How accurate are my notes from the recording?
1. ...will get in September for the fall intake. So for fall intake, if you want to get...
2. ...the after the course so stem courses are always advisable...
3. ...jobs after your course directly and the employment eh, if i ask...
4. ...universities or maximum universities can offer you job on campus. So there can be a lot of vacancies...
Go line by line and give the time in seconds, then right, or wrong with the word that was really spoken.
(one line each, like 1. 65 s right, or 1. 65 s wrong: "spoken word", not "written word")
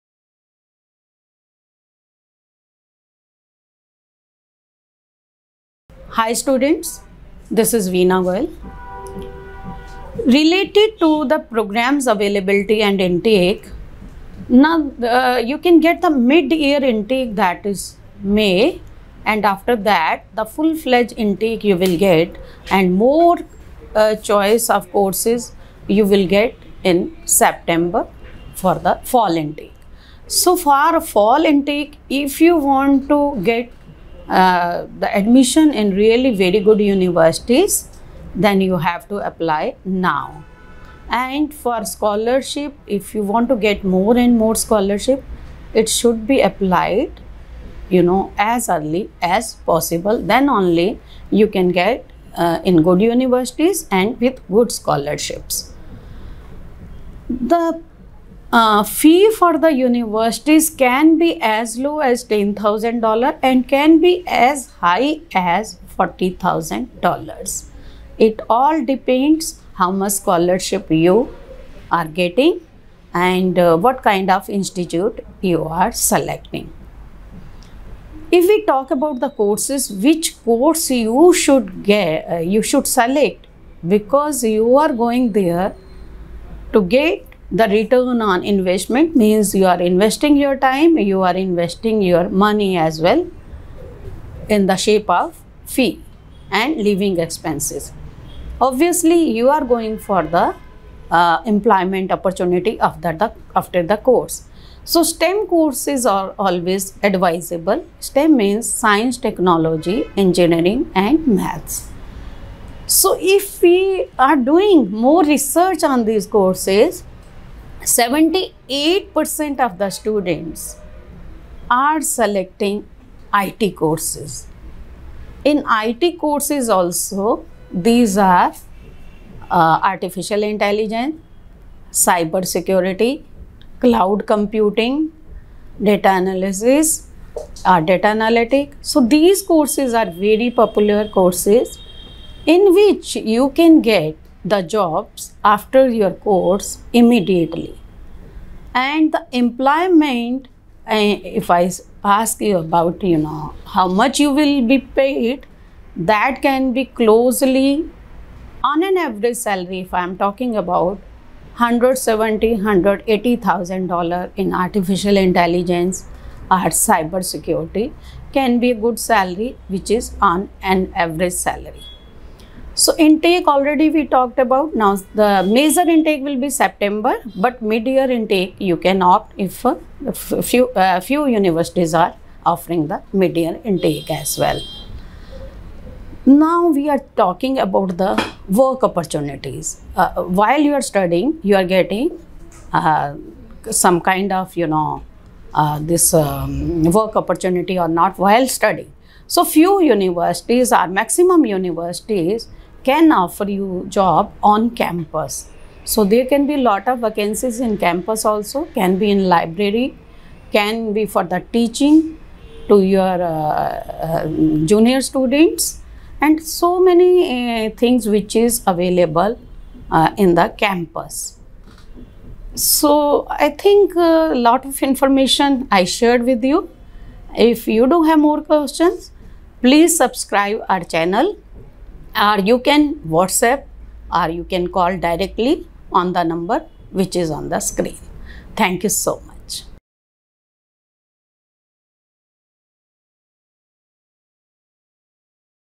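1. 26 s right
2. 103 s right
3. 144 s wrong: "immediately", not "directly"
4. 199 s right.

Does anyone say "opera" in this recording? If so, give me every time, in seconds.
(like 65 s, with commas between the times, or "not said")
not said.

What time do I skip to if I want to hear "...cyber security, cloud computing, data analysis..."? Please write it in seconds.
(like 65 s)
131 s.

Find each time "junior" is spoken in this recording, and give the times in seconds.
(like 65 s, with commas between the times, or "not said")
214 s.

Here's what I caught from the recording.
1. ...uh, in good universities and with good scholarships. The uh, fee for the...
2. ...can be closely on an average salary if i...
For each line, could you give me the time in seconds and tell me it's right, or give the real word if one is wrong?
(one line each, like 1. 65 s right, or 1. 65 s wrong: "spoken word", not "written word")
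1. 52 s right
2. 156 s right.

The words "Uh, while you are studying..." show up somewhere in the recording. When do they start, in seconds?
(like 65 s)
189 s.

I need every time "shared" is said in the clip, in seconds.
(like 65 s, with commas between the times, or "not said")
225 s.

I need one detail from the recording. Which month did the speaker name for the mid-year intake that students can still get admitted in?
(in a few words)
May.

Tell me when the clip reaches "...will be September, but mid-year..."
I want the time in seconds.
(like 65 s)
176 s.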